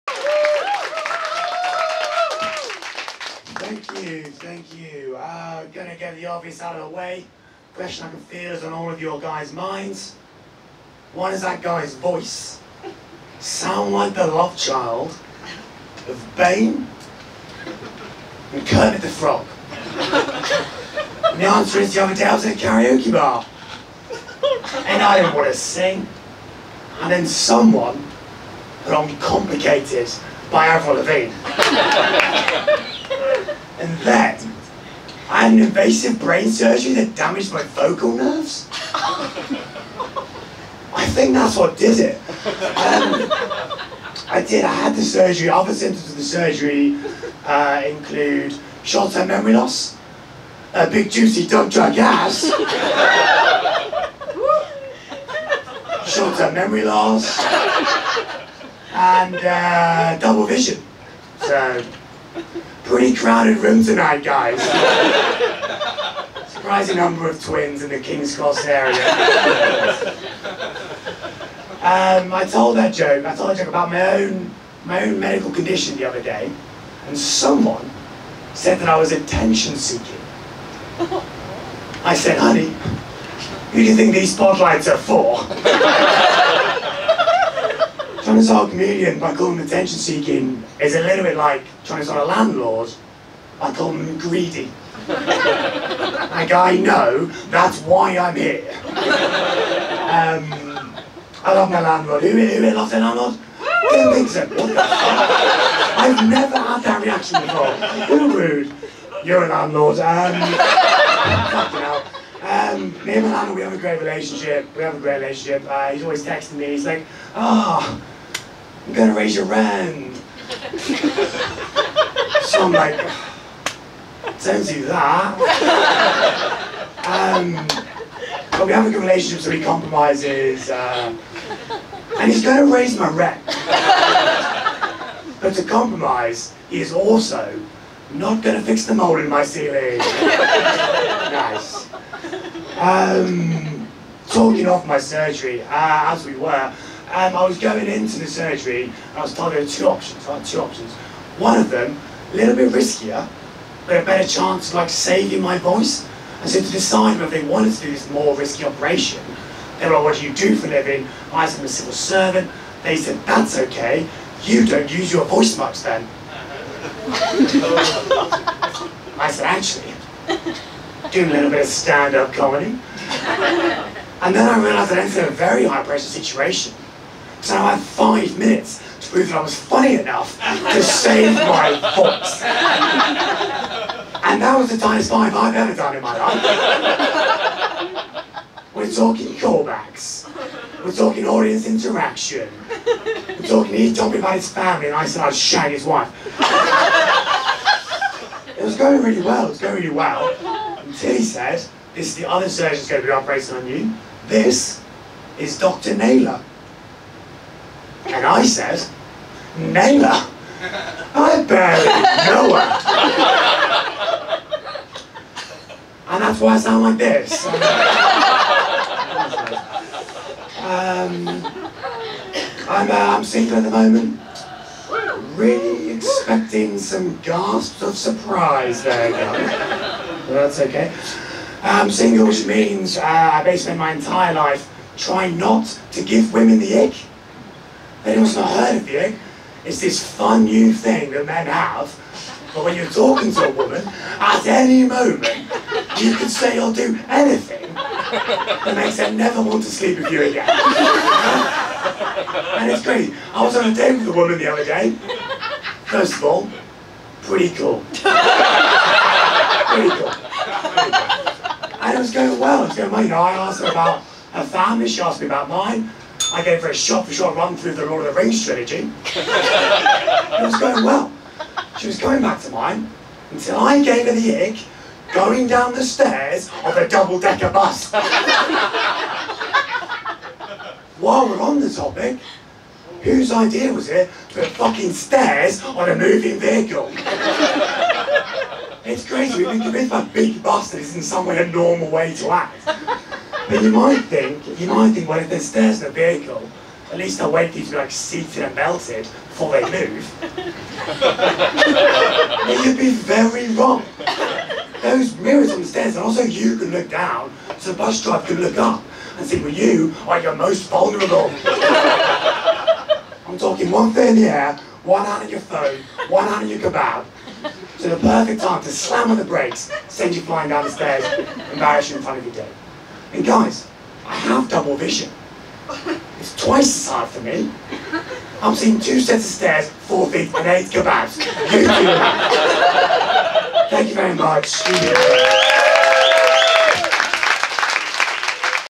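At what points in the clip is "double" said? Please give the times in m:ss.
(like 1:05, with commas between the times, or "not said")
1:00, 4:36, 5:24.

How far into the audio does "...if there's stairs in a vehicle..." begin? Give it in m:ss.
4:55.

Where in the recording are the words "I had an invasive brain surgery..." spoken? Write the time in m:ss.
0:35.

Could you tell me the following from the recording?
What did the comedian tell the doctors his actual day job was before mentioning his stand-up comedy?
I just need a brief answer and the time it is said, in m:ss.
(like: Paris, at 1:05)
Civil servant, at 2:41.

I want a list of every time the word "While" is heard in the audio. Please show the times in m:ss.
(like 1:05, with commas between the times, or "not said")
4:41.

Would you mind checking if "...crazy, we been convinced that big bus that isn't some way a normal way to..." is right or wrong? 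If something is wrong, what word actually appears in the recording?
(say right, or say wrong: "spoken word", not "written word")
right.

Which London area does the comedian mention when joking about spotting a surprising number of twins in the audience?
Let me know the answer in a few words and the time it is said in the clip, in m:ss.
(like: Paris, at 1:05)
King's Cross, at 1:08.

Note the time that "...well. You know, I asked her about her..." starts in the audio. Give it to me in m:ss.
4:22.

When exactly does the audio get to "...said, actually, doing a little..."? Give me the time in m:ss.
2:49.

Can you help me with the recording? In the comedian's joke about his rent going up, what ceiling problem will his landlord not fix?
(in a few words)
Mold.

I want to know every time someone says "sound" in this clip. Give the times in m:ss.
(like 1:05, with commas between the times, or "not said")
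0:13, 3:36.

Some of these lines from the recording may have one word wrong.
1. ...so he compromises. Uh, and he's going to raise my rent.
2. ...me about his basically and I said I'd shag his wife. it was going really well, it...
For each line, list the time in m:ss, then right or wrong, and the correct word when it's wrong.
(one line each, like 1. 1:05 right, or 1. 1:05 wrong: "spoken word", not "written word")
1. 2:09 right
2. 3:14 wrong: "family", not "basically".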